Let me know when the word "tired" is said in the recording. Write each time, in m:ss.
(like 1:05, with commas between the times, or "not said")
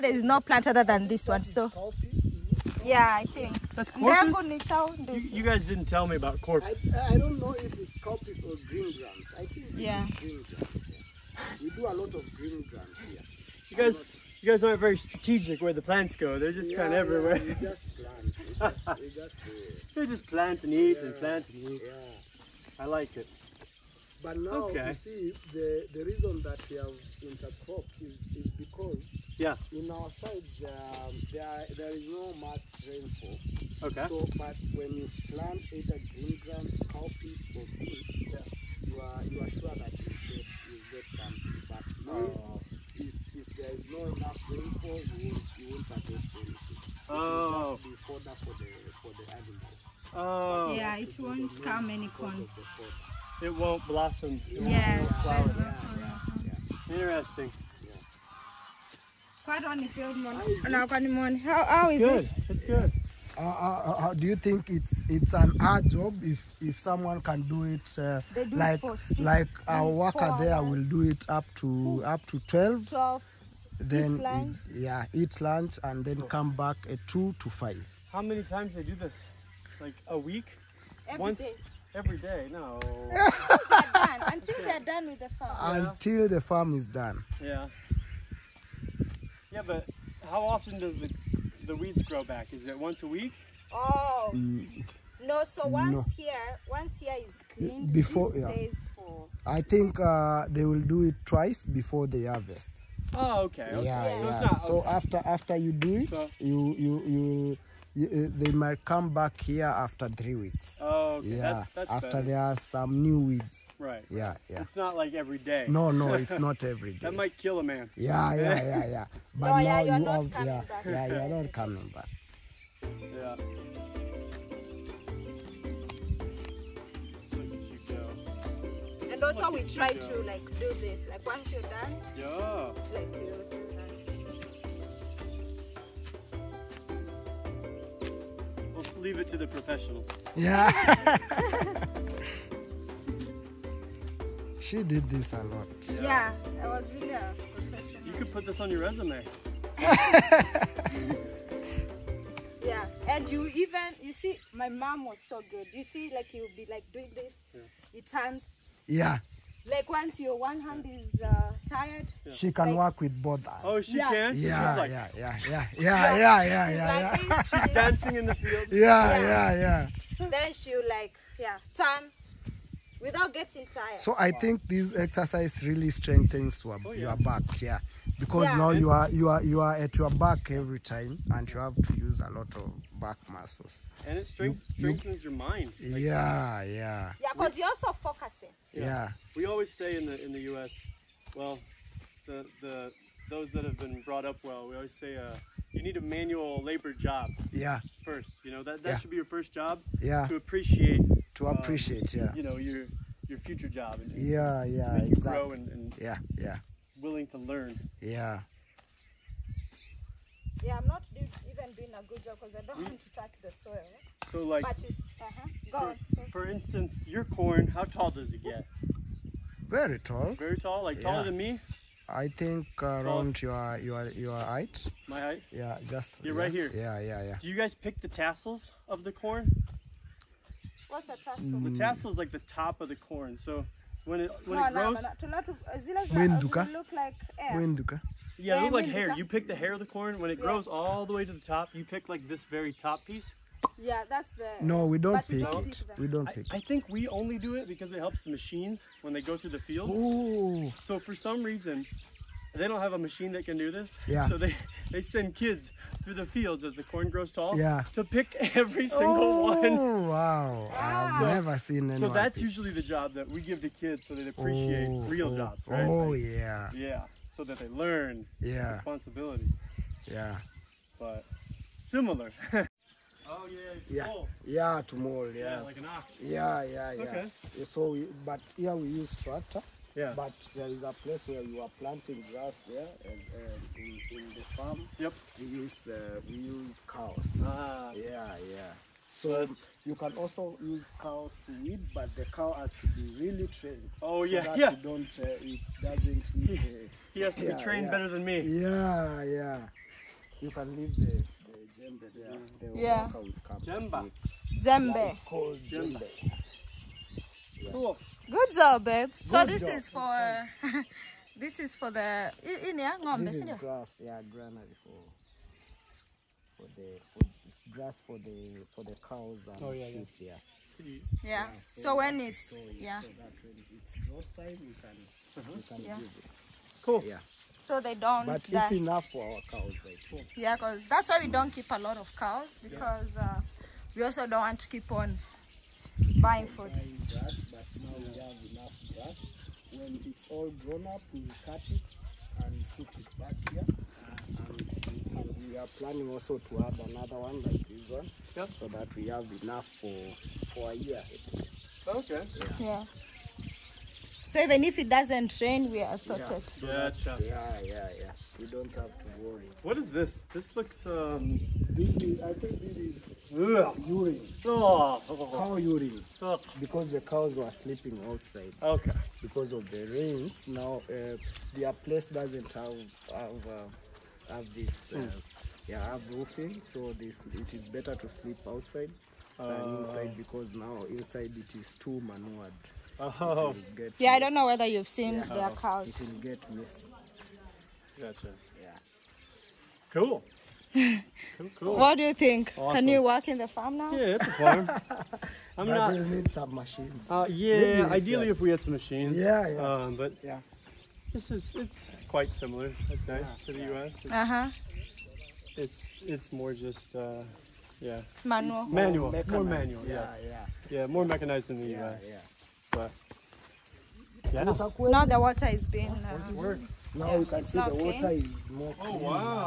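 2:41, 2:53.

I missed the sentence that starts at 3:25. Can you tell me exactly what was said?
grow and, and yeah yeah willing to learn.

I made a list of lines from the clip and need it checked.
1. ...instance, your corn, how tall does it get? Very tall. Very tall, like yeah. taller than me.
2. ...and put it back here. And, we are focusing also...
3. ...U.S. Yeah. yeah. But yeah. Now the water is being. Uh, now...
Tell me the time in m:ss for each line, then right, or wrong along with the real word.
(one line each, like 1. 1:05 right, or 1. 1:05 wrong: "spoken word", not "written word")
1. 3:36 right
2. 5:42 wrong: "planning", not "focusing"
3. 6:51 right.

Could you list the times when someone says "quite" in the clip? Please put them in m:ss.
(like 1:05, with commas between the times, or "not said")
0:59, 6:42.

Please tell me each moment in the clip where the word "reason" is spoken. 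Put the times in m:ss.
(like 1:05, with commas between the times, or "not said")
0:26, 4:11.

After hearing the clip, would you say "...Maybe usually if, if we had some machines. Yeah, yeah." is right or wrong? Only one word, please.
wrong.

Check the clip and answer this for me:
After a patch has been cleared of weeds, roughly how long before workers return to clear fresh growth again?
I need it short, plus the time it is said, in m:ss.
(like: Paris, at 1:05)
Three weeks, at 1:50.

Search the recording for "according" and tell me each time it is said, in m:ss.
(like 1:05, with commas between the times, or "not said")
not said.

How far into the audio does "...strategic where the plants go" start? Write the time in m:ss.
0:14.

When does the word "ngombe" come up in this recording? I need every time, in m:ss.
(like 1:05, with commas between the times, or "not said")
5:13.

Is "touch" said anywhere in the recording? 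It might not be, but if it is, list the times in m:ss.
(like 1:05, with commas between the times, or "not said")
3:33.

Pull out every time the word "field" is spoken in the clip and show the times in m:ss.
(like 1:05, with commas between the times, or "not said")
0:59, 2:48, 4:09, 4:16.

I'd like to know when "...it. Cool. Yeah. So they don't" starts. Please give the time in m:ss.
5:26.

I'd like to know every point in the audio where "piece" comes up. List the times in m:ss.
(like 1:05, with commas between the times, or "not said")
4:03.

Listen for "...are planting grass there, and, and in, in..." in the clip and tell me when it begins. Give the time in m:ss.
4:41.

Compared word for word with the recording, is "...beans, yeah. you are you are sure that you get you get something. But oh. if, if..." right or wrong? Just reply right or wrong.
right.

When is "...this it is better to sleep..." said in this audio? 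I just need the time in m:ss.
6:16.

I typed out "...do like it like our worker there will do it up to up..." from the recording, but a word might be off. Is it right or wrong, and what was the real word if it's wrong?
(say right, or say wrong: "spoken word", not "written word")
right.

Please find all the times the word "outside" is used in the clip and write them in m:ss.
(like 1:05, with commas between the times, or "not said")
6:08, 6:18.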